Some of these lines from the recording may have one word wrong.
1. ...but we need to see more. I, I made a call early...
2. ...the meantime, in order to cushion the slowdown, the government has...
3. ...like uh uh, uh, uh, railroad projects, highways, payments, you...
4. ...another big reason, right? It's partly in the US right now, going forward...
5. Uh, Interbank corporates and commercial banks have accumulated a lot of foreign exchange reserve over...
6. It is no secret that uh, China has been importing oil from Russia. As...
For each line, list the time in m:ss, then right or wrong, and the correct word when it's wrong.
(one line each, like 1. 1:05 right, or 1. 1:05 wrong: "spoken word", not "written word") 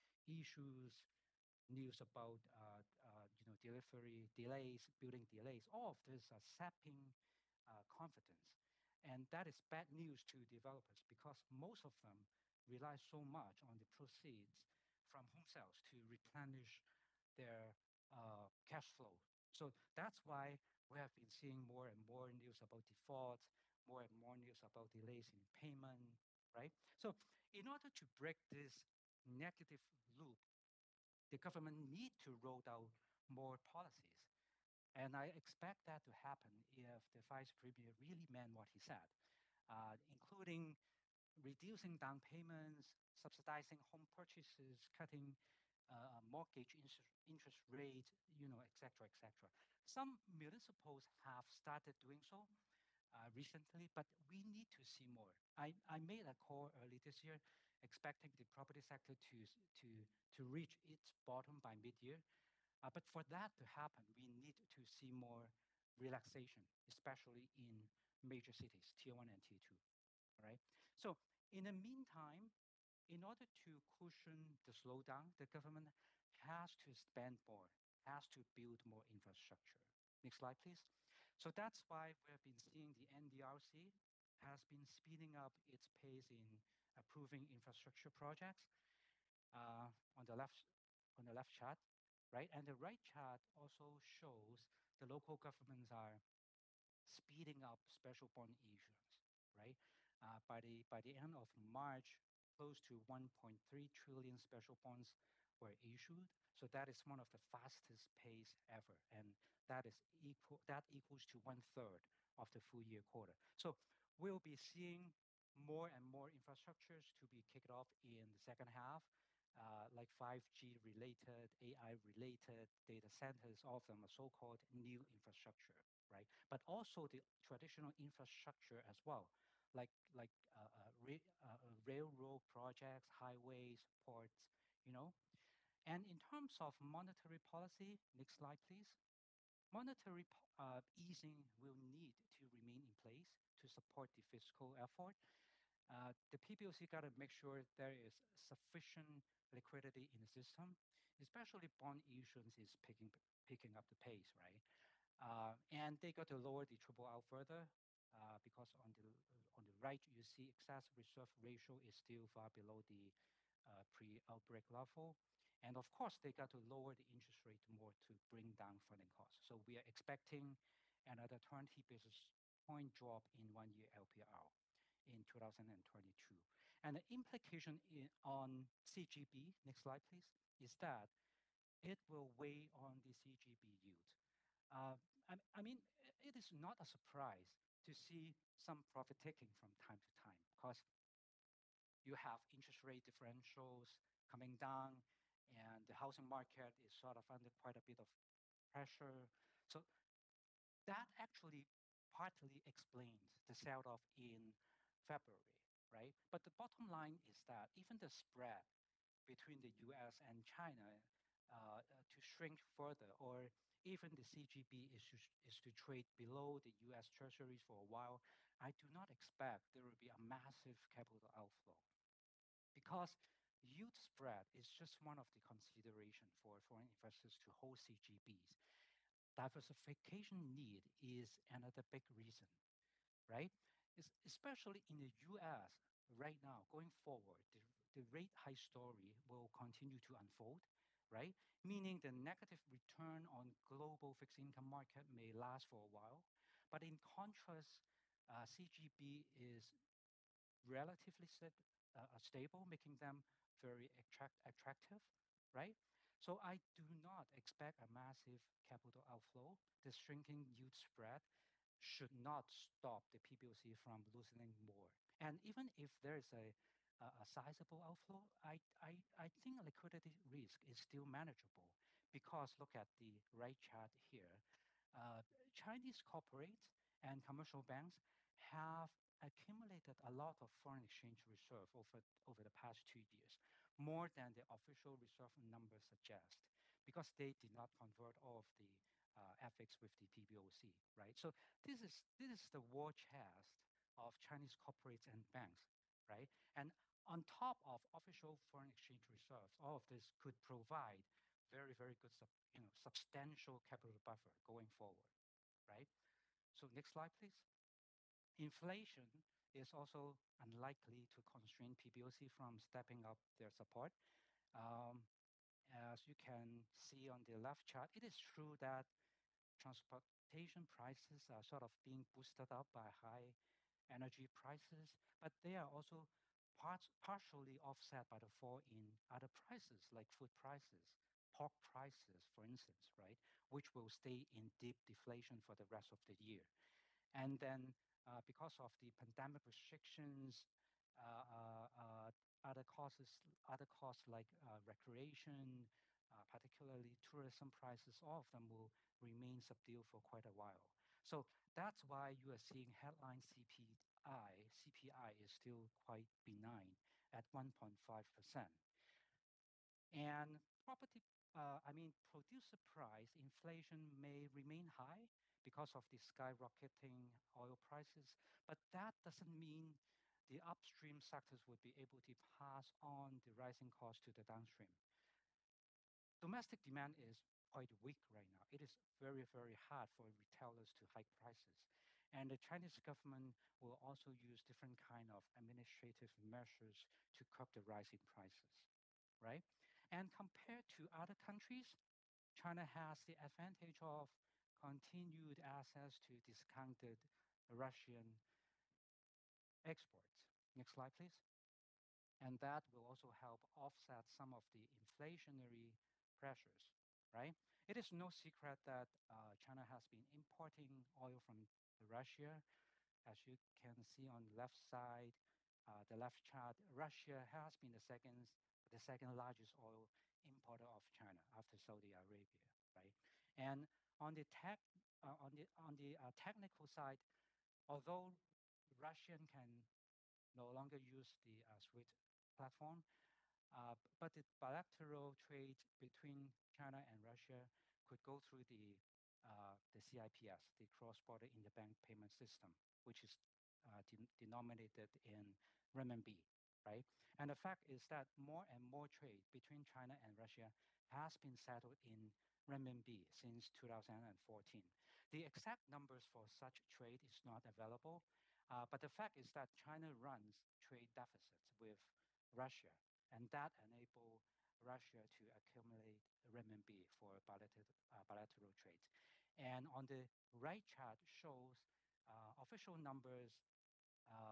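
1. 0:53 right
2. 1:11 right
3. 2:10 wrong: "ports", not "payments"
4. 3:51 wrong: "especially", not "partly"
5. 4:34 wrong: "Chinese", not "Interbank"
6. 6:47 right.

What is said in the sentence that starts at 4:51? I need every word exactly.
So this is, this is the war chest of Chinese corporates and banks, right?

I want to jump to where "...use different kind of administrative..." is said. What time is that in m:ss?
6:24.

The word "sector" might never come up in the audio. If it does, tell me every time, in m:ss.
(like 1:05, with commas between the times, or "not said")
0:58, 6:11.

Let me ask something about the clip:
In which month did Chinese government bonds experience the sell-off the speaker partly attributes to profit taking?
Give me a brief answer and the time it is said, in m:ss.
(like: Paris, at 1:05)
February, at 3:25.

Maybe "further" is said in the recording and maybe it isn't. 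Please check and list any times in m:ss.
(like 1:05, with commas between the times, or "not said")
2:37, 3:32.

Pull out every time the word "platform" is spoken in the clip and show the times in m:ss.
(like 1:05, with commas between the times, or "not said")
7:12.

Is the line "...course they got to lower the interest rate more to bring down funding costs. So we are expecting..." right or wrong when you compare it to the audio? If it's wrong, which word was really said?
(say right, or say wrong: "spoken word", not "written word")
right.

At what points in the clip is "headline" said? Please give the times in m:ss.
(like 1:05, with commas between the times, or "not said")
5:52.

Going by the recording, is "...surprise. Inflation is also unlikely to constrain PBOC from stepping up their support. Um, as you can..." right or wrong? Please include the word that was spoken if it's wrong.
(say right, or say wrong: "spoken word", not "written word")
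wrong: "please", not "surprise".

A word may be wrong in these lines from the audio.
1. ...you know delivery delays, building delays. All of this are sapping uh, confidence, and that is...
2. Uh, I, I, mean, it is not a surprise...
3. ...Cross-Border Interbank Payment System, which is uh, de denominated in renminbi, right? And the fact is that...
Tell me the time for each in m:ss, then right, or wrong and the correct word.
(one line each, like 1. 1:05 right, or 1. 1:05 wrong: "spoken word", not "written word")
1. 0:03 right
2. 3:04 right
3. 7:20 right.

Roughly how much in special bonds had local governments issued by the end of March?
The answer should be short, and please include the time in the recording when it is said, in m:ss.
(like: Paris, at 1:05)
1.3 trillion, at 1:43.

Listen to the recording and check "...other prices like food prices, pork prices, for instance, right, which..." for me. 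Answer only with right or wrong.
right.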